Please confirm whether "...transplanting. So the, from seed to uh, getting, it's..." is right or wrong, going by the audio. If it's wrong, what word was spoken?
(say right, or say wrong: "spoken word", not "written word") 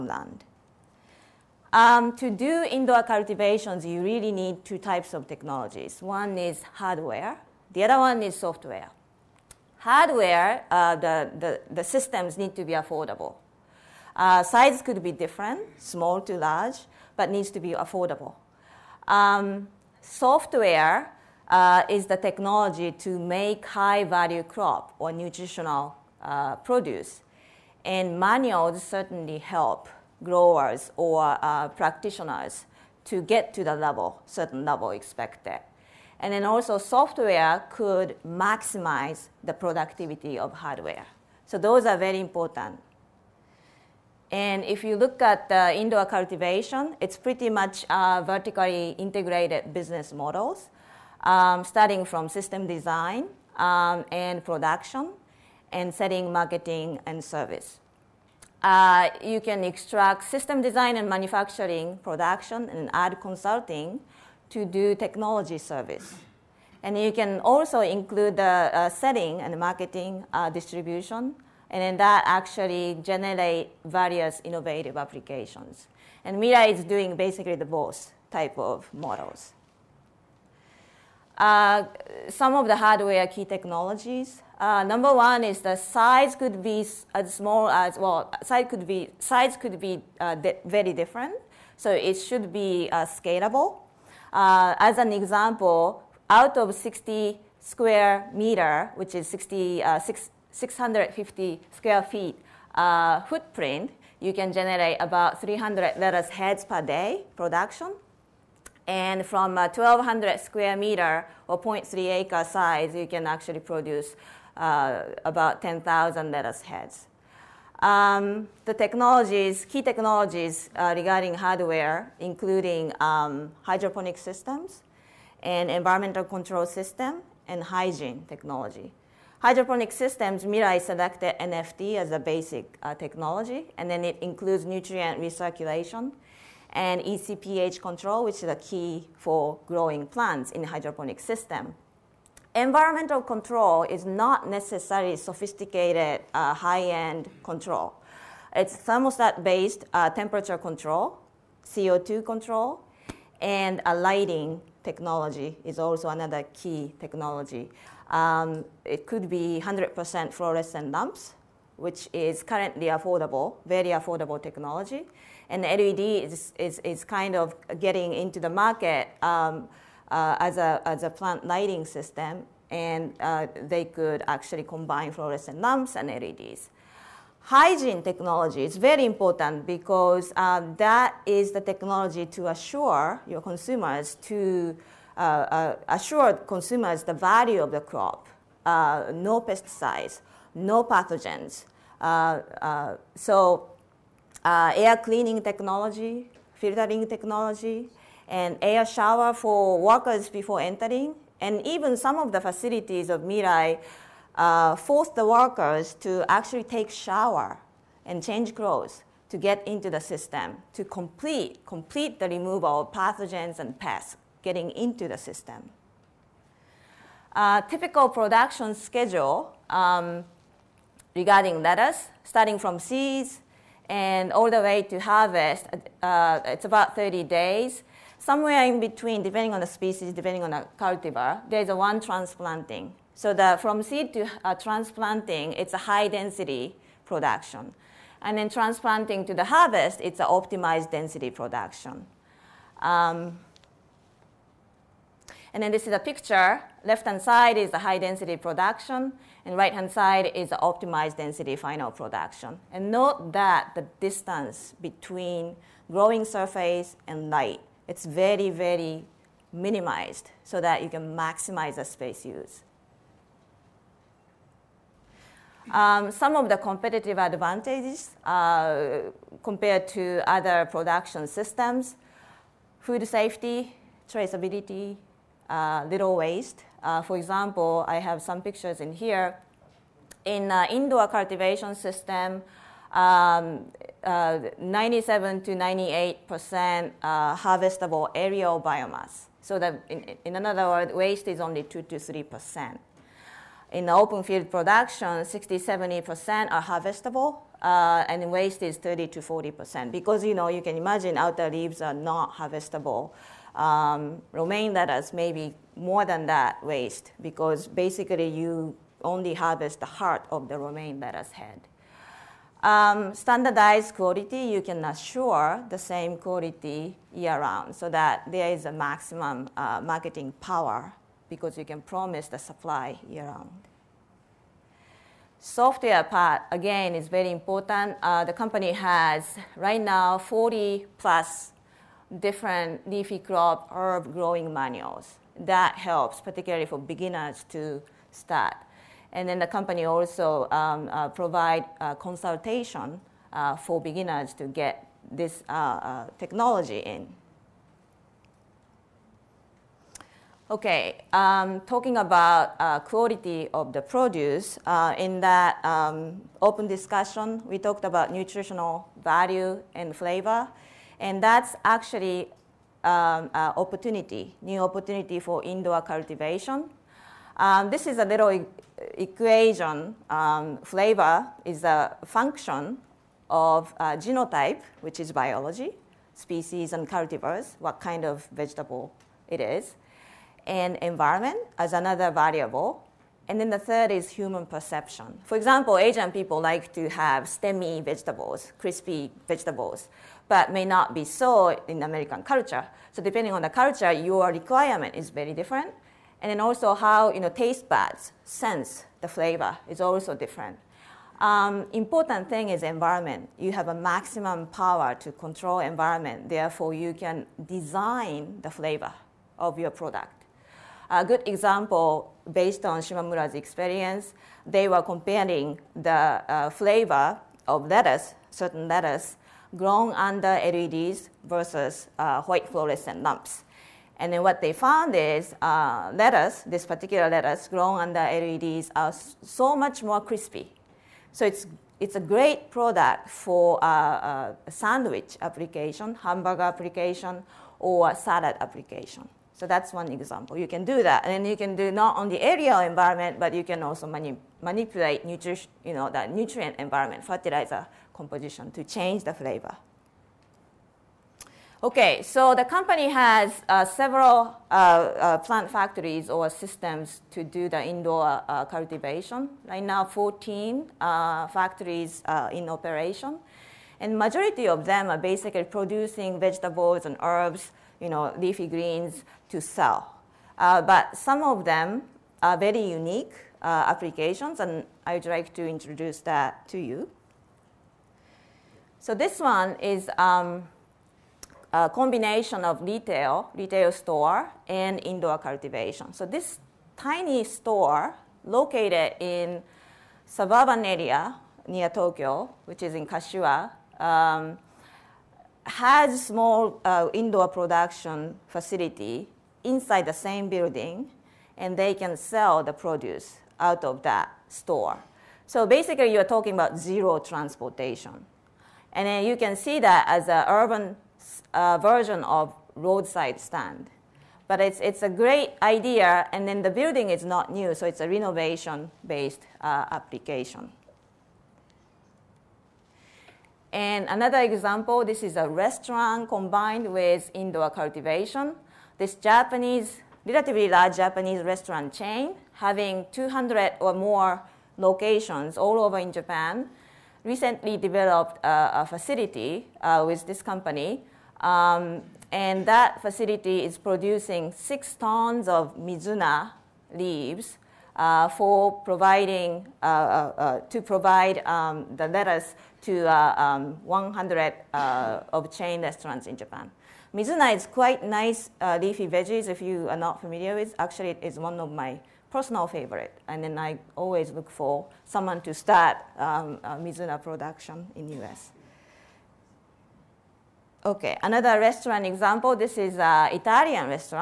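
wrong: "transplanting", not "getting".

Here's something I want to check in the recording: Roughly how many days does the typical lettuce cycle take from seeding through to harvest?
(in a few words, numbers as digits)
30 days.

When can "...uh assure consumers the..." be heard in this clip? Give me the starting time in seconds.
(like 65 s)
185 s.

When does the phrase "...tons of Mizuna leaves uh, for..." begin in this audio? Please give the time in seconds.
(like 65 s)
544 s.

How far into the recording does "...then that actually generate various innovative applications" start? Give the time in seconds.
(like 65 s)
71 s.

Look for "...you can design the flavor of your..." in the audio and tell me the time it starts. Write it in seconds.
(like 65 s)
406 s.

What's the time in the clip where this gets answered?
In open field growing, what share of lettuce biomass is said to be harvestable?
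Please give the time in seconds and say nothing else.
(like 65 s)
295 s.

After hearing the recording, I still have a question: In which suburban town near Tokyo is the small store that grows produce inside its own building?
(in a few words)
Kashiwa.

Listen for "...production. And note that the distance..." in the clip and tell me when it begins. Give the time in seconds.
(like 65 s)
251 s.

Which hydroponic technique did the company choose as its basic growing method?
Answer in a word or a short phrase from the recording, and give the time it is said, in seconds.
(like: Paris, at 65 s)
NFT, at 131 s.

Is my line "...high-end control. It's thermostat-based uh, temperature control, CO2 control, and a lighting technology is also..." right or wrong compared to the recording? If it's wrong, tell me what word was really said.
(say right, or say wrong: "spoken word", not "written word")
right.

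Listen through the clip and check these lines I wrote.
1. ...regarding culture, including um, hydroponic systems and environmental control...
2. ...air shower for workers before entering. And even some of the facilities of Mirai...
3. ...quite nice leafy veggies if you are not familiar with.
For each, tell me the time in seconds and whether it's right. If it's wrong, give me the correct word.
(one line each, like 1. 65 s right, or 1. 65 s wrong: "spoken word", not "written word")
1. 120 s wrong: "hardware", not "culture"
2. 198 s right
3. 557 s right.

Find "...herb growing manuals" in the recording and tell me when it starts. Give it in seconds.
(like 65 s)
333 s.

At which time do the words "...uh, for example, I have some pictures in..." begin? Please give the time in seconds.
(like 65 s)
276 s.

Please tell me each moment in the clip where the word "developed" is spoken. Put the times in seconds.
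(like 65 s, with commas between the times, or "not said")
537 s.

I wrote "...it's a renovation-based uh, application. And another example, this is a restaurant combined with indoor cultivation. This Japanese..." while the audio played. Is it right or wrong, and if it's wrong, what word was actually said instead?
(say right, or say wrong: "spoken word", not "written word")
right.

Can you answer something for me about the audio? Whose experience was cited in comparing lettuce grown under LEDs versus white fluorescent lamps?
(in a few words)
Shimamura.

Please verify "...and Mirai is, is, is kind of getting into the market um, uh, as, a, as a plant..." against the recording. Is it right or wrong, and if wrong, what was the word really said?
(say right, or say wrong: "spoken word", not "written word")
wrong: "LED", not "Mirai".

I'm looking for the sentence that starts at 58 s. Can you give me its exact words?
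Uh, you can extract system design and manufacturing, production, and add consulting to do technology service.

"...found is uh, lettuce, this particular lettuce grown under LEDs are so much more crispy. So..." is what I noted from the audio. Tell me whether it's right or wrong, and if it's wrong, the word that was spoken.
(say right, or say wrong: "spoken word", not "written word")
right.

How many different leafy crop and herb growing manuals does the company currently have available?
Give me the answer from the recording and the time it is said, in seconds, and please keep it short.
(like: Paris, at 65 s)
40 plus, at 330 s.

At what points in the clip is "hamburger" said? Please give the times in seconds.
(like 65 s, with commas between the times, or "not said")
435 s.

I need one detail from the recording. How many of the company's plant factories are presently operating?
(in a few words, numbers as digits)
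14.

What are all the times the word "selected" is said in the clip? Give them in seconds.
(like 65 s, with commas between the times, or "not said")
130 s.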